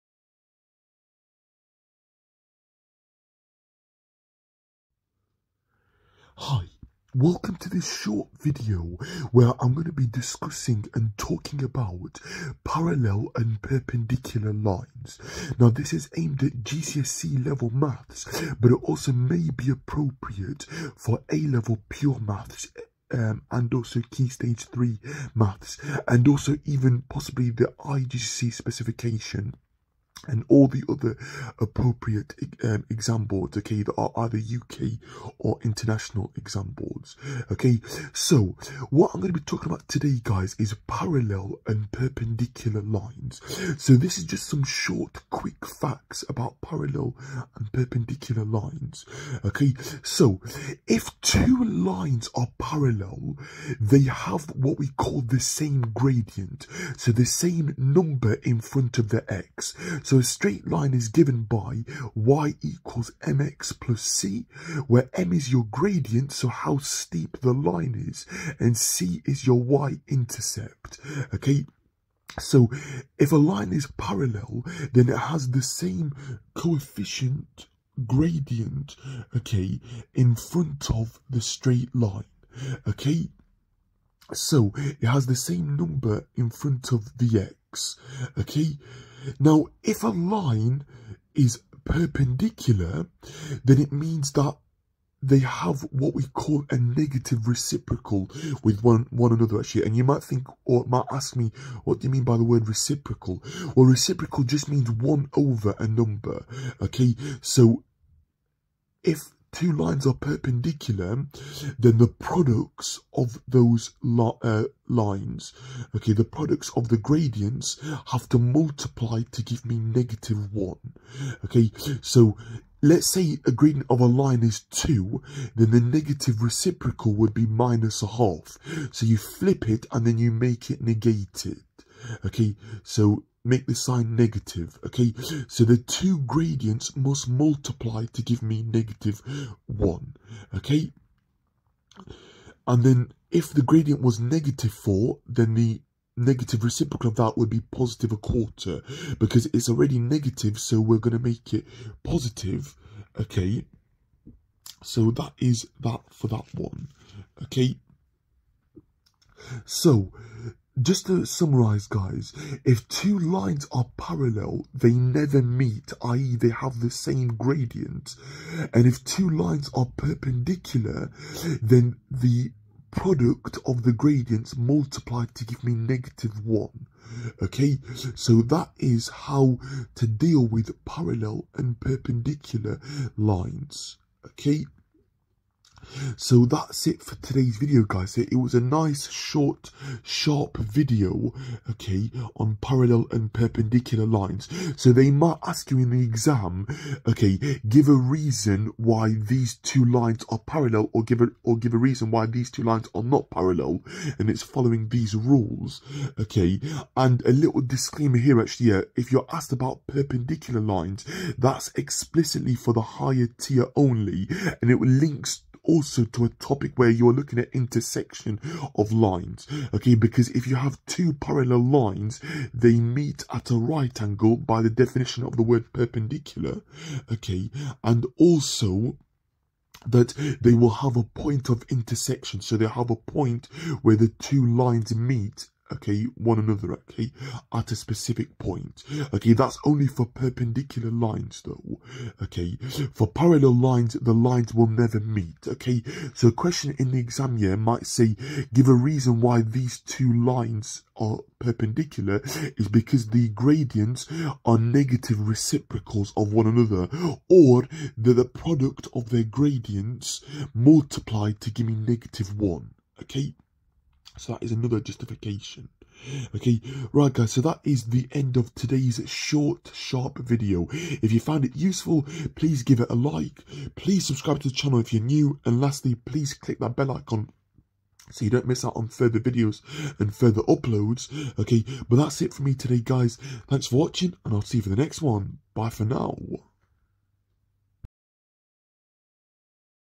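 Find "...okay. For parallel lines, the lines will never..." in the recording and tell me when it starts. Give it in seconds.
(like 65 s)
242 s.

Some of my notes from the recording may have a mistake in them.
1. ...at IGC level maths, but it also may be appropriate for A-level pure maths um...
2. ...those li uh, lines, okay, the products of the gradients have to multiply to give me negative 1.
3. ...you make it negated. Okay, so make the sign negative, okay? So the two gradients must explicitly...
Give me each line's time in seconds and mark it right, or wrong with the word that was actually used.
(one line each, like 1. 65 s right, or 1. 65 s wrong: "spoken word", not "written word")
1. 16 s wrong: "GCSE", not "IGC"
2. 113 s right
3. 130 s wrong: "multiply", not "explicitly".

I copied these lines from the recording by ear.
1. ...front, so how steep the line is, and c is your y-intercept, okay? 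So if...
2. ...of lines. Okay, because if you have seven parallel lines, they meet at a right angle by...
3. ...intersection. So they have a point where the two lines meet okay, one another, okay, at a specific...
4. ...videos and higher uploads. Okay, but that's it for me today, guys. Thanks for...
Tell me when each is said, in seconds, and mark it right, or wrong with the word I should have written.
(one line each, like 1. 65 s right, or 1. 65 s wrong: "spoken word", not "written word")
1. 65 s wrong: "gradient", not "front"
2. 218 s wrong: "two", not "seven"
3. 231 s right
4. 279 s wrong: "further", not "higher".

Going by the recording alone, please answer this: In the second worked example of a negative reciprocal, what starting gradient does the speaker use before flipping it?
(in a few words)
-4.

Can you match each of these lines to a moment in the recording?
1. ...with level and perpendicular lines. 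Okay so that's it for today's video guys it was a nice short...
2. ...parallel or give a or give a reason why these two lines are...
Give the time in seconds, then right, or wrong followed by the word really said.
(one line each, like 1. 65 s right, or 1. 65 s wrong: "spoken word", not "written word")
1. 180 s wrong: "parallel", not "level"
2. 200 s right.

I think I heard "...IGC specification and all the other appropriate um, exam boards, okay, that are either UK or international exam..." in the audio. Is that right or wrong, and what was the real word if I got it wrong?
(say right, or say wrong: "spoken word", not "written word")
right.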